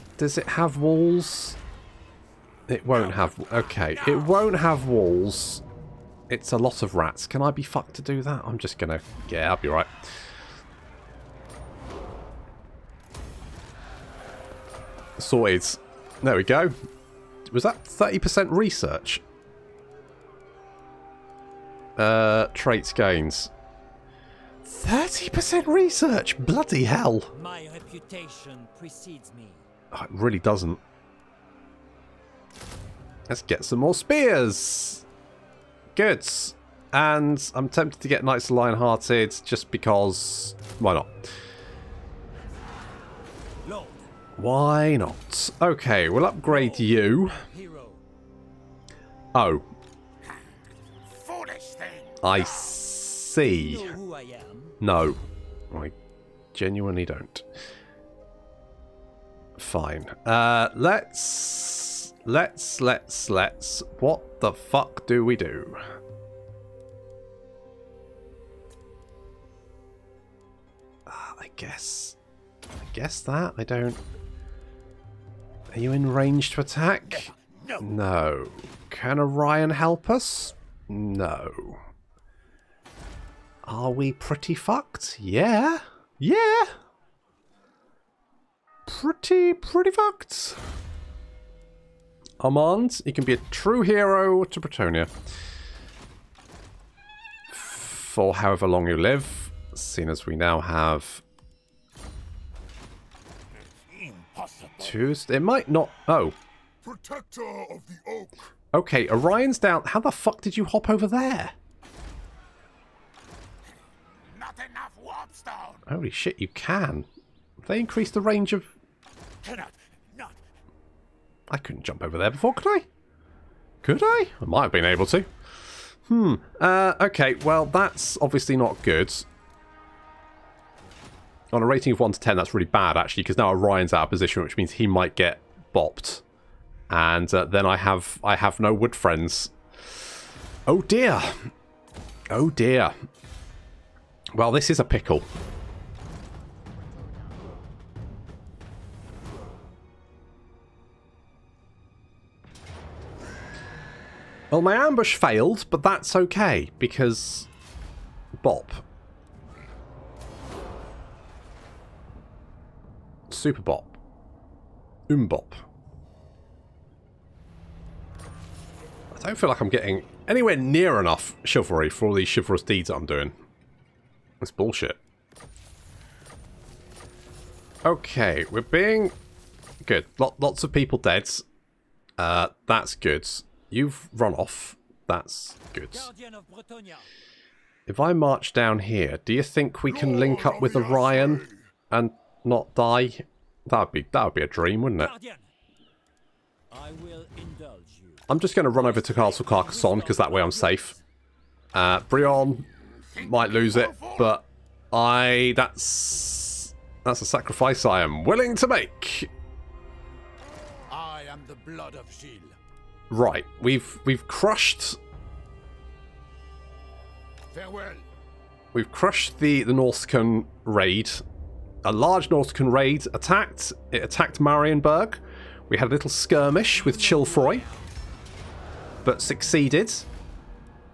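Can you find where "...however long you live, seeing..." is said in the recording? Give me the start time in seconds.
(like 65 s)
98 s.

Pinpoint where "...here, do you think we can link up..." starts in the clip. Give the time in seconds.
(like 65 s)
188 s.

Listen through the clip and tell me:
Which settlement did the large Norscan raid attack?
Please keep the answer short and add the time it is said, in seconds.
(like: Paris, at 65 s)
Marienburg, at 224 s.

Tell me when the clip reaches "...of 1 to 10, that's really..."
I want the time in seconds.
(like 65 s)
131 s.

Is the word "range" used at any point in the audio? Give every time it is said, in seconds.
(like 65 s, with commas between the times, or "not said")
76 s, 118 s.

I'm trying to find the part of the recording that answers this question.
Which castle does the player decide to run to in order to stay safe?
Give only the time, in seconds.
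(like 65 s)
199 s.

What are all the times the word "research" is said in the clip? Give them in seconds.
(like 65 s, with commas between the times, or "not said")
18 s, 25 s.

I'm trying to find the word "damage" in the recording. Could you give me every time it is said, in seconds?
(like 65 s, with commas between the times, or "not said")
not said.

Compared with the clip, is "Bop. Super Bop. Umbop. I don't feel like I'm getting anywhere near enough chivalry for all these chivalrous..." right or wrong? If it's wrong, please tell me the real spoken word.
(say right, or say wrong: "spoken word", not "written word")
right.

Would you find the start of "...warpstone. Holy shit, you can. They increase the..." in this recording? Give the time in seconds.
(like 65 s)
115 s.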